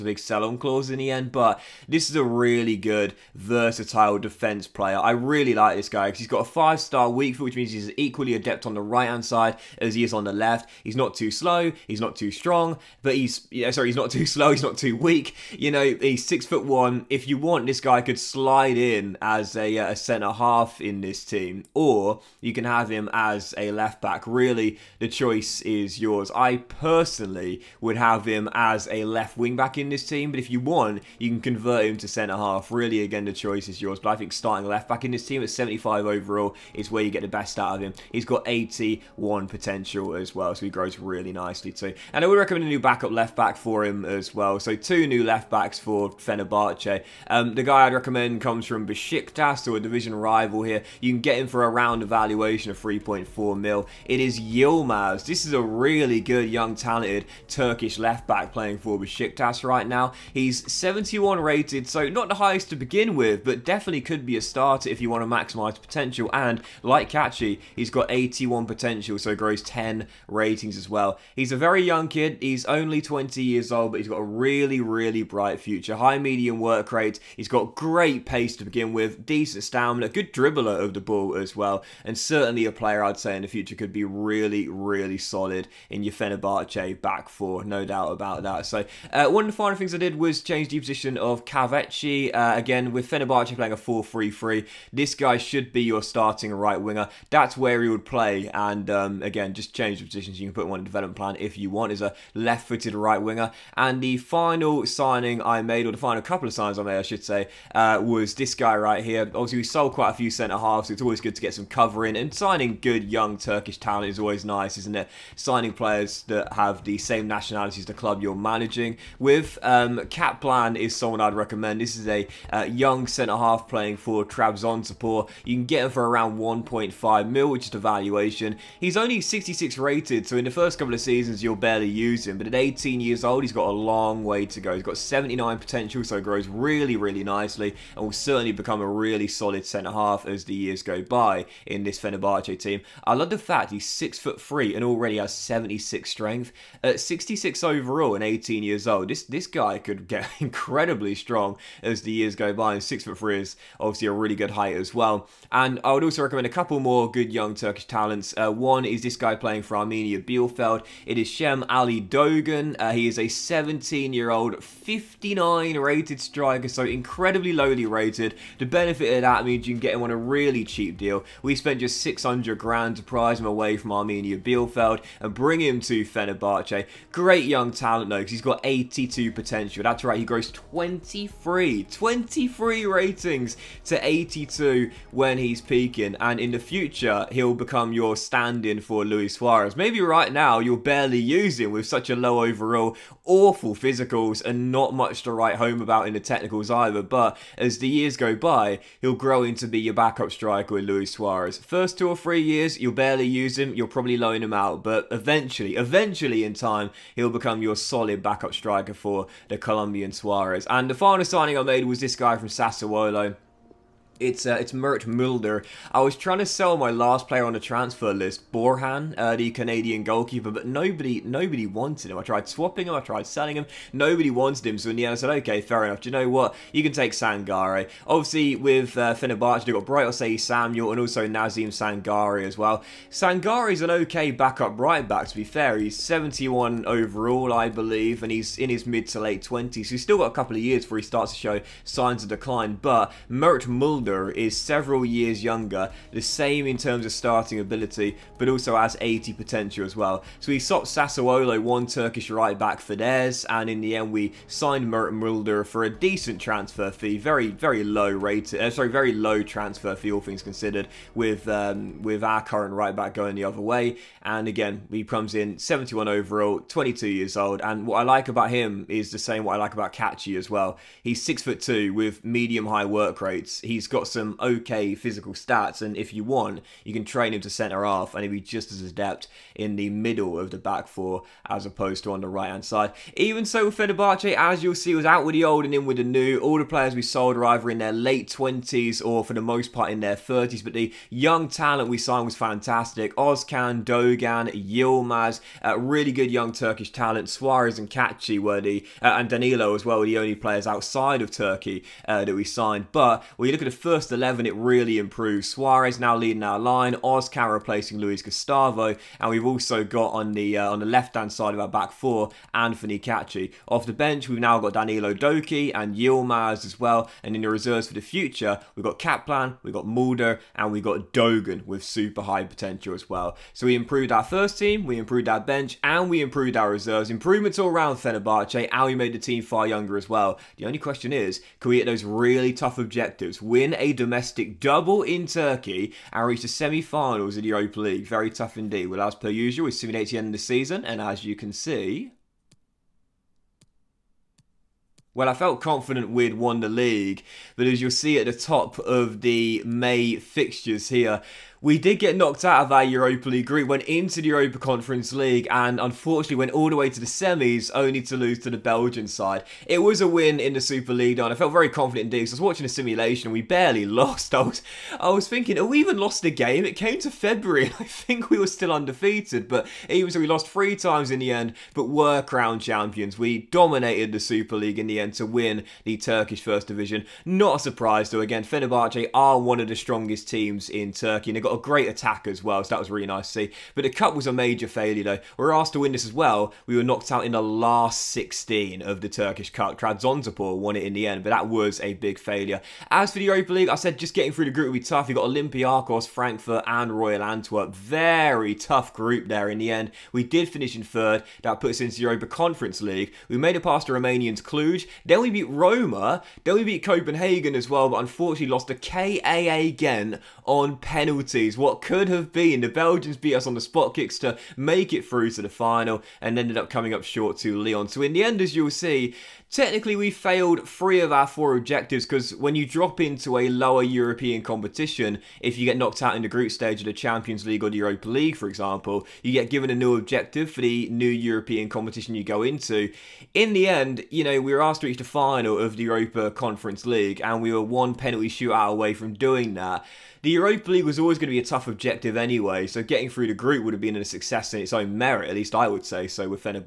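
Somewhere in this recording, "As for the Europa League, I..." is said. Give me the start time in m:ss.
6:32.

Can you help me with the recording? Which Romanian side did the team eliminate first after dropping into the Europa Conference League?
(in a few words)
Cluj.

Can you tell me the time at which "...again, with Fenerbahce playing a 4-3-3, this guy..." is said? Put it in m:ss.
1:32.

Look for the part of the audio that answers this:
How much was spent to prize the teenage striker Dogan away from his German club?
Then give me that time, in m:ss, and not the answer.
2:52.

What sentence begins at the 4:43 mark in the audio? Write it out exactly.
Even so, with Fenerbahce, as you'll see, was out with the old and in with the new.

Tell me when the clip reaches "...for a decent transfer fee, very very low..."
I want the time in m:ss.
4:15.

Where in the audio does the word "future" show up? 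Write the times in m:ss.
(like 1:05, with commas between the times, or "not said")
1:15, 1:23, 3:06, 5:18.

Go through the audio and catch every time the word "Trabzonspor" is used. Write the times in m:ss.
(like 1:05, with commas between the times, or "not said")
2:04, 6:29.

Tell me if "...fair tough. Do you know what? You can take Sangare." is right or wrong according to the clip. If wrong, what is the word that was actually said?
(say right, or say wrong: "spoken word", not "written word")
wrong: "enough", not "tough".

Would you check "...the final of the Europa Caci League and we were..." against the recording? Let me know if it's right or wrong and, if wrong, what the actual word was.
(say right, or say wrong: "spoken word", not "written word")
wrong: "Conference", not "Caci".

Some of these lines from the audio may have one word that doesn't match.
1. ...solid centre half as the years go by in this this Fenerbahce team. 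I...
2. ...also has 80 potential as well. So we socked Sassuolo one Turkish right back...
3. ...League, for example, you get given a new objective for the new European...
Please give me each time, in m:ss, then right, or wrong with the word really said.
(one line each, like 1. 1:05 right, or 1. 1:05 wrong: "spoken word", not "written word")
1. 2:19 right
2. 4:08 right
3. 7:08 right.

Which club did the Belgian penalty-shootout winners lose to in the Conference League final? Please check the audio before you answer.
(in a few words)
Leon.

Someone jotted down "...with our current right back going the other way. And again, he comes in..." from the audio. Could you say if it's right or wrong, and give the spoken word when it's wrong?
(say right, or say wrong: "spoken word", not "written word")
right.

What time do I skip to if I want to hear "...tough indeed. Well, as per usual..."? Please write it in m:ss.
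5:38.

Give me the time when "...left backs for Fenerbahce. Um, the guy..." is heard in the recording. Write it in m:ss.
0:45.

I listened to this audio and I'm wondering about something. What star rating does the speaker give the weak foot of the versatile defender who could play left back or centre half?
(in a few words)
5-star.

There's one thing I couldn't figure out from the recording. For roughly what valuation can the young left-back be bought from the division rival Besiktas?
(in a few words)
3.4 million.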